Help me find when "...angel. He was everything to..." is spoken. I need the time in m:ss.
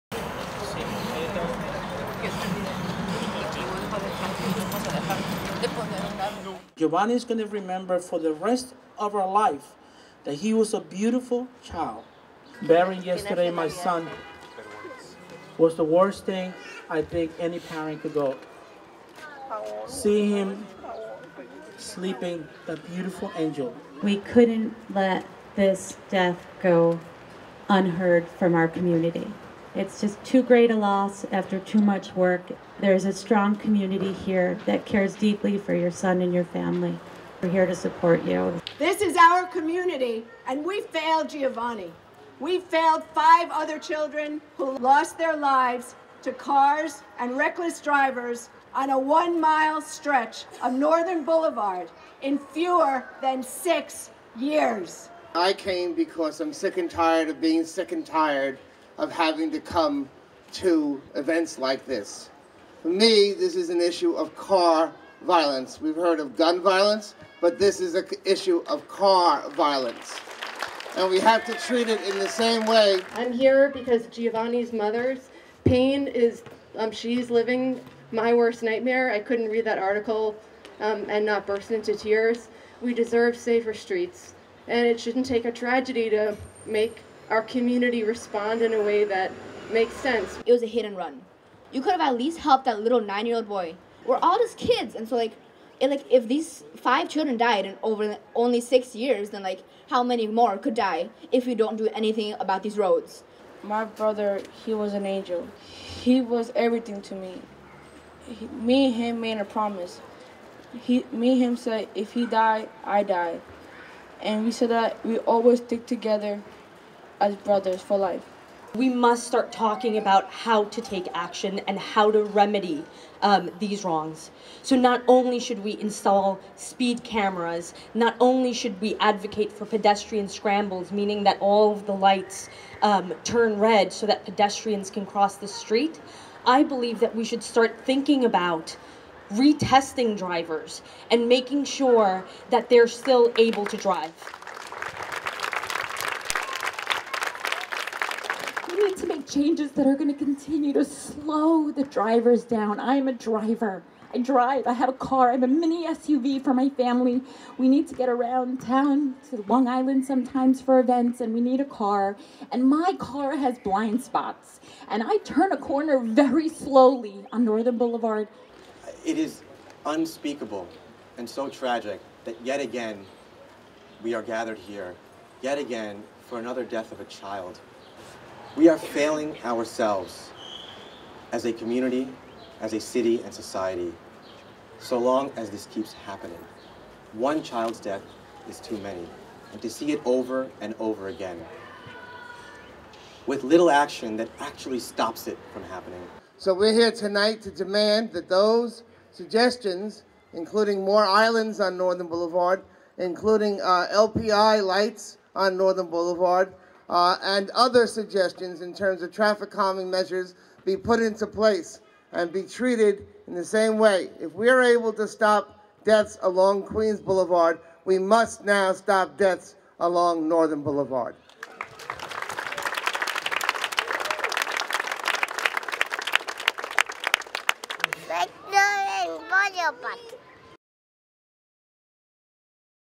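1:45.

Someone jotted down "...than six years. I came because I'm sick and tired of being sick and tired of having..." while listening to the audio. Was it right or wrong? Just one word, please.
right.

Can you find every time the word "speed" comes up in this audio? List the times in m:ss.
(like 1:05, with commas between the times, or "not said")
2:06.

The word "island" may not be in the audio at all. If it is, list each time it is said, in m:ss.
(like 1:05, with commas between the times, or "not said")
2:39, 3:21.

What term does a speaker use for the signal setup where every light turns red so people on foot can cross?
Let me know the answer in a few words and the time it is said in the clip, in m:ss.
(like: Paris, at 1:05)
pedestrian scrambles, at 2:09.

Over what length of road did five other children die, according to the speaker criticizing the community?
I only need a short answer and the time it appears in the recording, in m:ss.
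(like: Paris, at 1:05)
1 mile, at 0:48.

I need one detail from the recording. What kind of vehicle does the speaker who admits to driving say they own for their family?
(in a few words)
mini SUV.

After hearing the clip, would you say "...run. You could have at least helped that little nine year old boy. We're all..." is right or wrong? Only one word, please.
right.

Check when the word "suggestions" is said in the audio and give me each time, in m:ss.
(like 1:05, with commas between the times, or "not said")
3:19, 3:27.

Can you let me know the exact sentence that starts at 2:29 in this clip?
changes that are going to continue to slow the drivers down.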